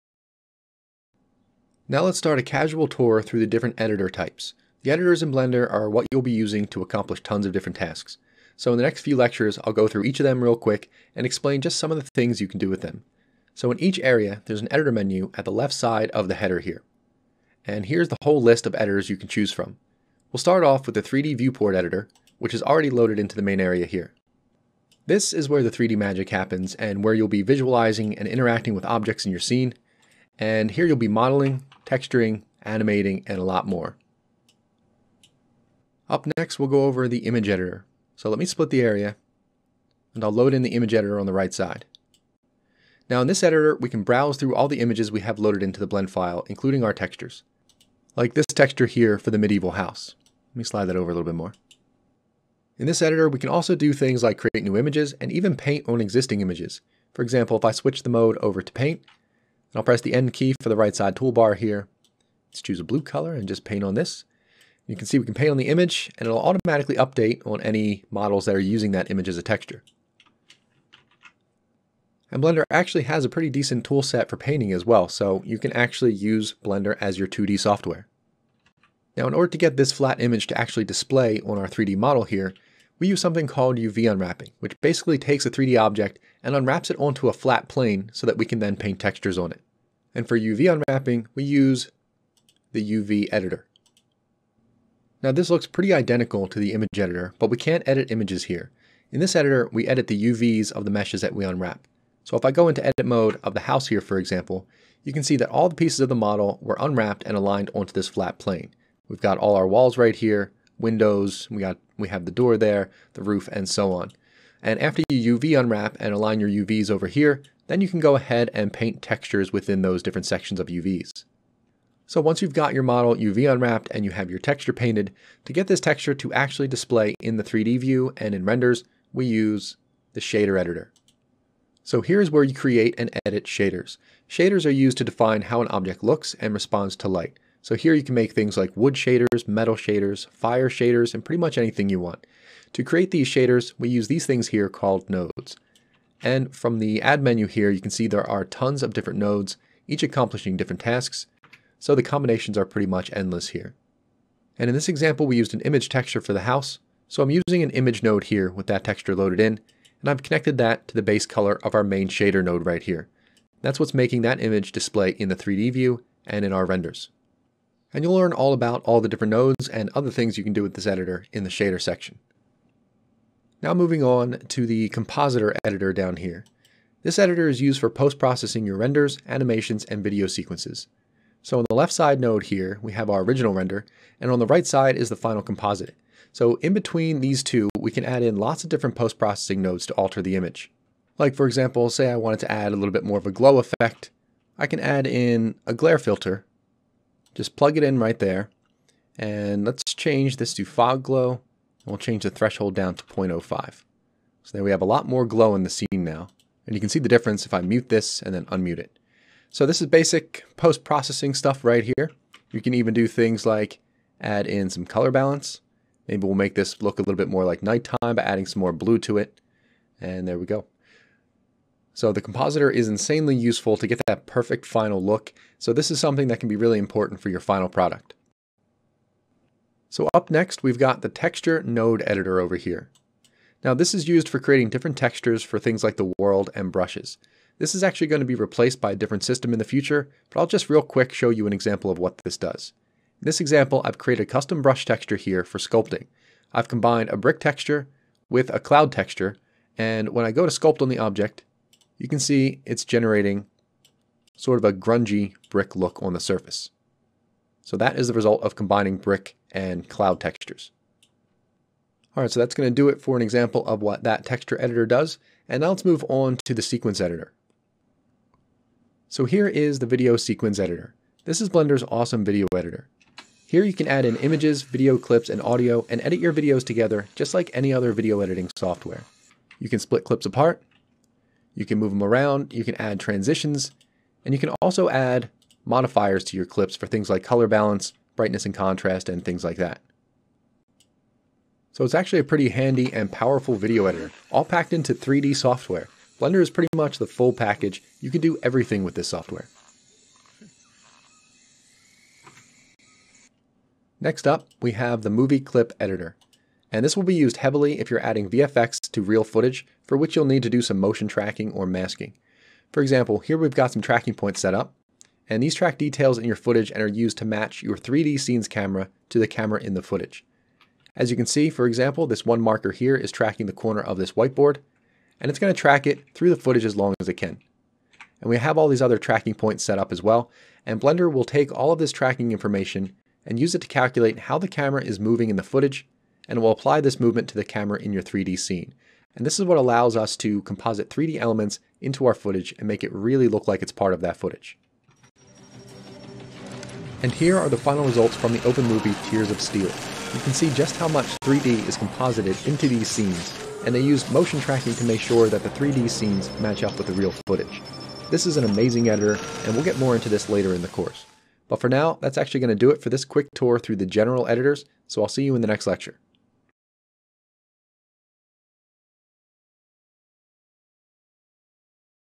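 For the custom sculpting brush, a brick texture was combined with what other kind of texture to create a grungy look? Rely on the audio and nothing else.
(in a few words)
cloud texture.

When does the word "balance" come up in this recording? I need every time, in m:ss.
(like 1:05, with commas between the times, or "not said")
3:35, 4:47.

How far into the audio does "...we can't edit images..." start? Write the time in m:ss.
1:37.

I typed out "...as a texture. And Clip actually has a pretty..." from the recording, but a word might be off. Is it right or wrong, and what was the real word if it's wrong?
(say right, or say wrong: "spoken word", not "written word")
wrong: "Blender", not "Clip".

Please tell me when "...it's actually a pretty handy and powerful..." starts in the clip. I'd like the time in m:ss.
4:51.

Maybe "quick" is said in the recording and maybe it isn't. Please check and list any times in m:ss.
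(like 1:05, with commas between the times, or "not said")
0:10, 4:00, 6:03.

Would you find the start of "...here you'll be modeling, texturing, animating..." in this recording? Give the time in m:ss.
0:30.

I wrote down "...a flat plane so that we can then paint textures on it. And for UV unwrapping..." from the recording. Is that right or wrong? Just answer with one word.
right.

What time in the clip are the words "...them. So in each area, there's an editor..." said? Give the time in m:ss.
0:12.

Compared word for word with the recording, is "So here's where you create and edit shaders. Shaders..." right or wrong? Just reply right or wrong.
right.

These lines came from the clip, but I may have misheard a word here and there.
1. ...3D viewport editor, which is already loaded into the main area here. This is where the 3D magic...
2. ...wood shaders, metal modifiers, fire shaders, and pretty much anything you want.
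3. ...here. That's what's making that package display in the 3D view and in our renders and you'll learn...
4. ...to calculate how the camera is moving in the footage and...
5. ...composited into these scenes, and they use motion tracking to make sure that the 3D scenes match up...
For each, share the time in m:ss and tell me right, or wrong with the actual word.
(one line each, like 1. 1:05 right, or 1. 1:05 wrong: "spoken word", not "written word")
1. 0:21 right
2. 2:18 wrong: "shaders", not "modifiers"
3. 2:42 wrong: "image", not "package"
4. 5:33 right
5. 5:51 right.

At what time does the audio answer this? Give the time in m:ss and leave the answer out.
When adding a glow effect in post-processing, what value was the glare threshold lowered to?
3:23.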